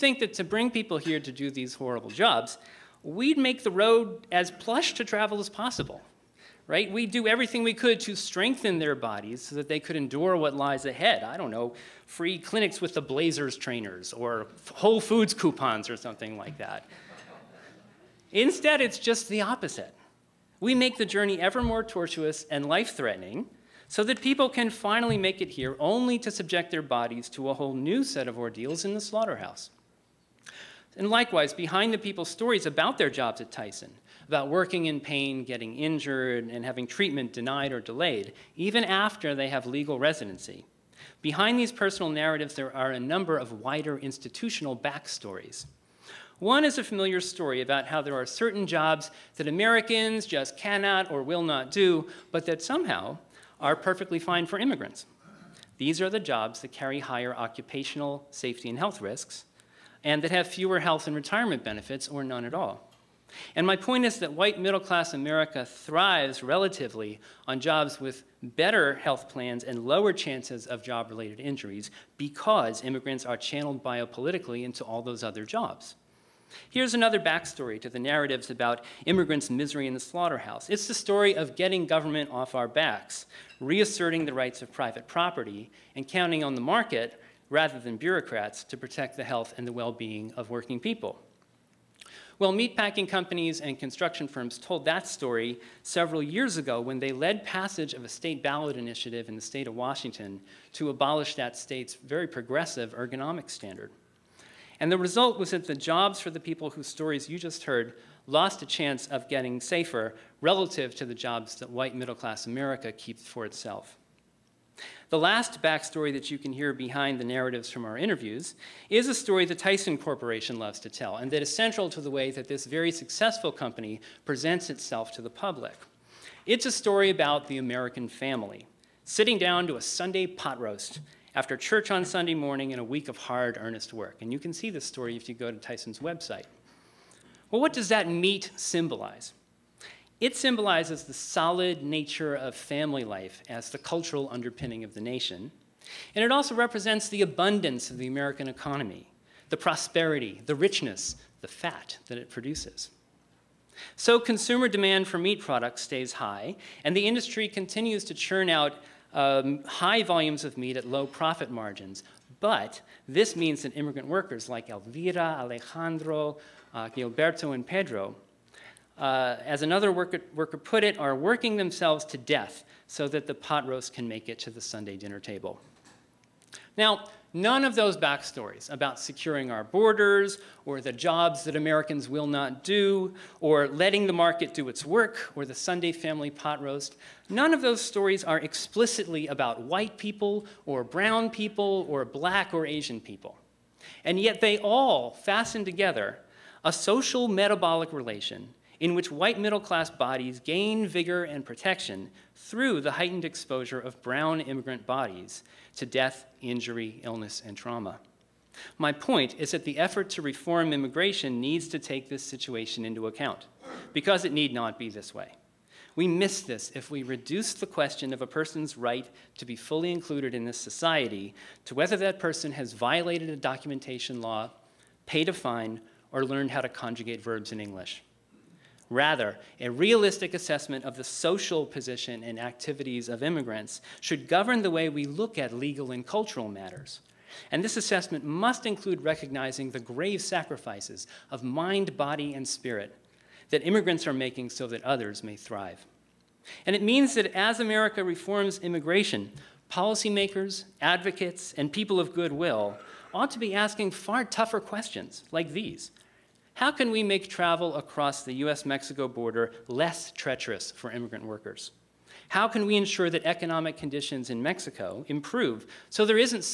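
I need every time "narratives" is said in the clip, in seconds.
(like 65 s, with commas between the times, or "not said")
42 s, 77 s, 117 s.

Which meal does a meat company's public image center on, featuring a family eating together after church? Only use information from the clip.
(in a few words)
Sunday pot roast.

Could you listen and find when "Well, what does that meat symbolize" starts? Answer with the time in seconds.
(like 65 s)
137 s.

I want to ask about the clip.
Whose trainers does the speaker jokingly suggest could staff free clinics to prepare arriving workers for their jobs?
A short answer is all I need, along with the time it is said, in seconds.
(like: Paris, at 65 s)
Blazers, at 13 s.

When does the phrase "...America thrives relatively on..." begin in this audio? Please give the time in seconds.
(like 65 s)
65 s.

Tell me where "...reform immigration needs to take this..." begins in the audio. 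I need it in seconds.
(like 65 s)
210 s.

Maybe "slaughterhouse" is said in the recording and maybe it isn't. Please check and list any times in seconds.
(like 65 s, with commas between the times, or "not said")
29 s, 80 s.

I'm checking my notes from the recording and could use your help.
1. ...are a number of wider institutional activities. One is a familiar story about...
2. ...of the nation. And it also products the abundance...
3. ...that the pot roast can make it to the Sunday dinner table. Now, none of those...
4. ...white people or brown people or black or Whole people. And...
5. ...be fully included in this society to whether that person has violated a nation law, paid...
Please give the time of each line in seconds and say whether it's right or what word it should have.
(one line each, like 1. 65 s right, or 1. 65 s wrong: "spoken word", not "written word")
1. 42 s wrong: "backstories", not "activities"
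2. 144 s wrong: "represents", not "products"
3. 173 s right
4. 189 s wrong: "Asian", not "Whole"
5. 219 s wrong: "documentation", not "nation".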